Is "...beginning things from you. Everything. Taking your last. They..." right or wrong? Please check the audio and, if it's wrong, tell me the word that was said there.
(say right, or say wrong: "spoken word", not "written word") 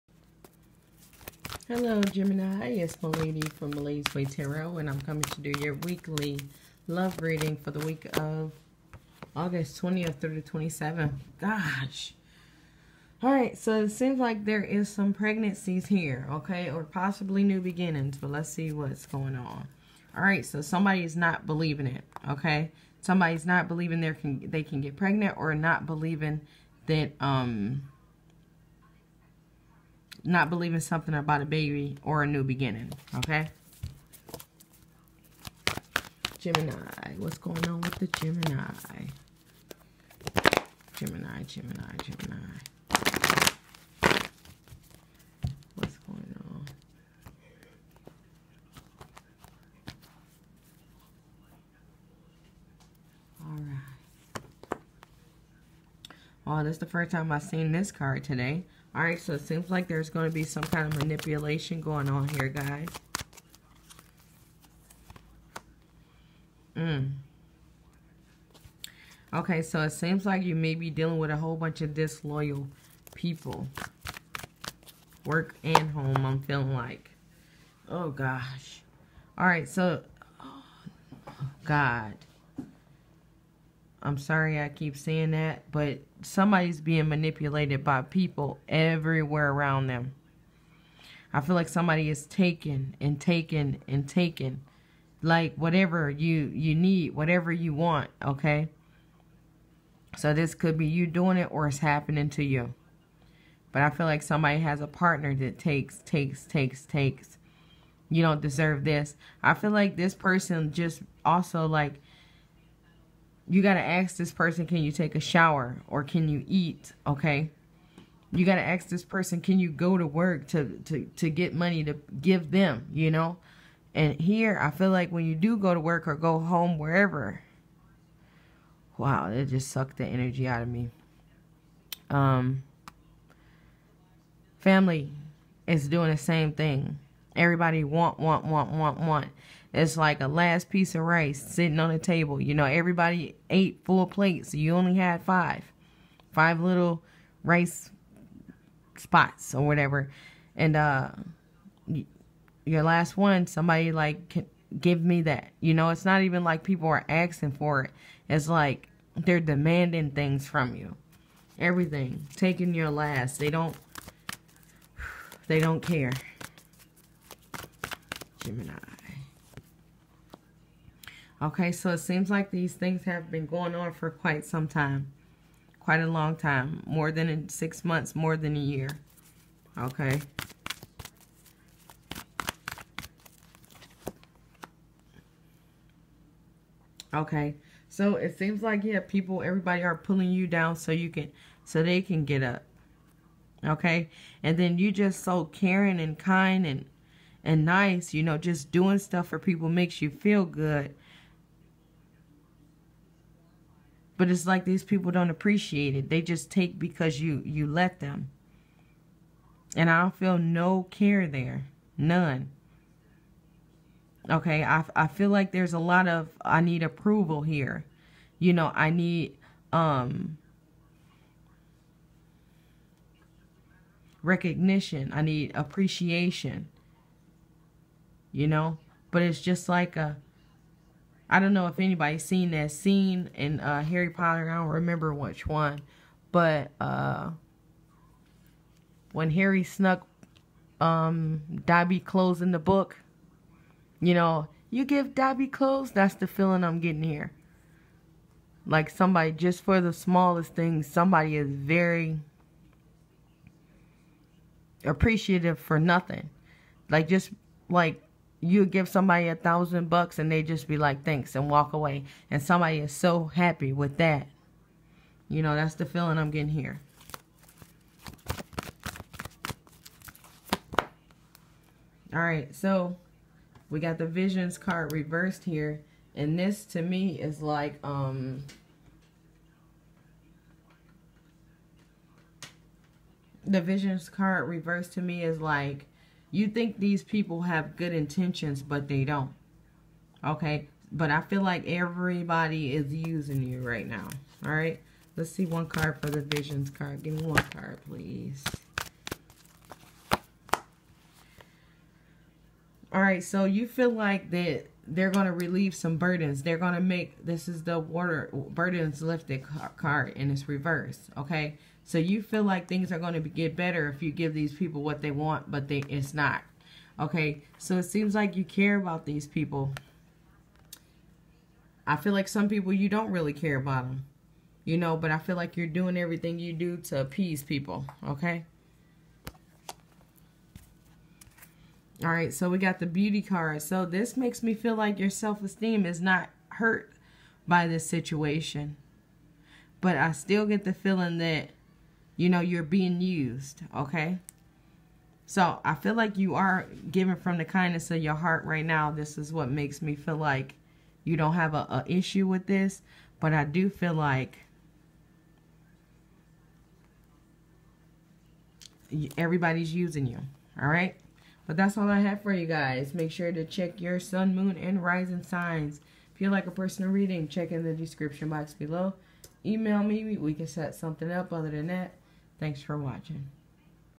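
wrong: "demanding", not "beginning".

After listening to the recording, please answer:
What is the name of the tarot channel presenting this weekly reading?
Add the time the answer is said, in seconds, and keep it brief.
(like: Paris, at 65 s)
Milady's Way Tarot, at 3 s.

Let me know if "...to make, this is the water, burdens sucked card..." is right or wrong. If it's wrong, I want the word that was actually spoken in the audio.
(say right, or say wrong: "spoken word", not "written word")
wrong: "lifted", not "sucked".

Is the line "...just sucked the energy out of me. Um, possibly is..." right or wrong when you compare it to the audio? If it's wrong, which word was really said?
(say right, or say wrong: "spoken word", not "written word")
wrong: "family", not "possibly".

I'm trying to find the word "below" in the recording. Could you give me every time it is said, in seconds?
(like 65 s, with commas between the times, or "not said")
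368 s.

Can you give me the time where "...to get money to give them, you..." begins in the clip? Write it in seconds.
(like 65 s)
121 s.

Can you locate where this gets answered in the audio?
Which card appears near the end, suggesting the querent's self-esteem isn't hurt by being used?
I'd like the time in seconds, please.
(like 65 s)
332 s.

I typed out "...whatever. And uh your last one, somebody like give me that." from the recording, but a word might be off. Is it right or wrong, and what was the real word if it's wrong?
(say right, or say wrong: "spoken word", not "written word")
right.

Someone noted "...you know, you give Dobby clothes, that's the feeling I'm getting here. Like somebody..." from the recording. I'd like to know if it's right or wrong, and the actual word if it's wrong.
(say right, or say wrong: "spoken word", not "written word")
right.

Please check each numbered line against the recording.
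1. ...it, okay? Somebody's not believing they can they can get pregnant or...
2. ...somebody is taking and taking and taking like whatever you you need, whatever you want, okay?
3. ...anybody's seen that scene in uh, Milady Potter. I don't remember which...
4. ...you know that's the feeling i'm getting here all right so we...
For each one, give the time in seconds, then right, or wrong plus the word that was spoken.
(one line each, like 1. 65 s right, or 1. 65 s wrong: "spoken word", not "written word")
1. 21 s right
2. 91 s right
3. 231 s wrong: "Harry", not "Milady"
4. 265 s right.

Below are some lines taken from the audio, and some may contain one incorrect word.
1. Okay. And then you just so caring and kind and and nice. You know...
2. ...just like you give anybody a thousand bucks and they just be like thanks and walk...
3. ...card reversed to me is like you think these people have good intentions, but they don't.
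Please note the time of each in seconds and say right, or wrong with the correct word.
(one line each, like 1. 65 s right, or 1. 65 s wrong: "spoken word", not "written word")
1. 193 s right
2. 257 s wrong: "somebody", not "anybody"
3. 284 s right.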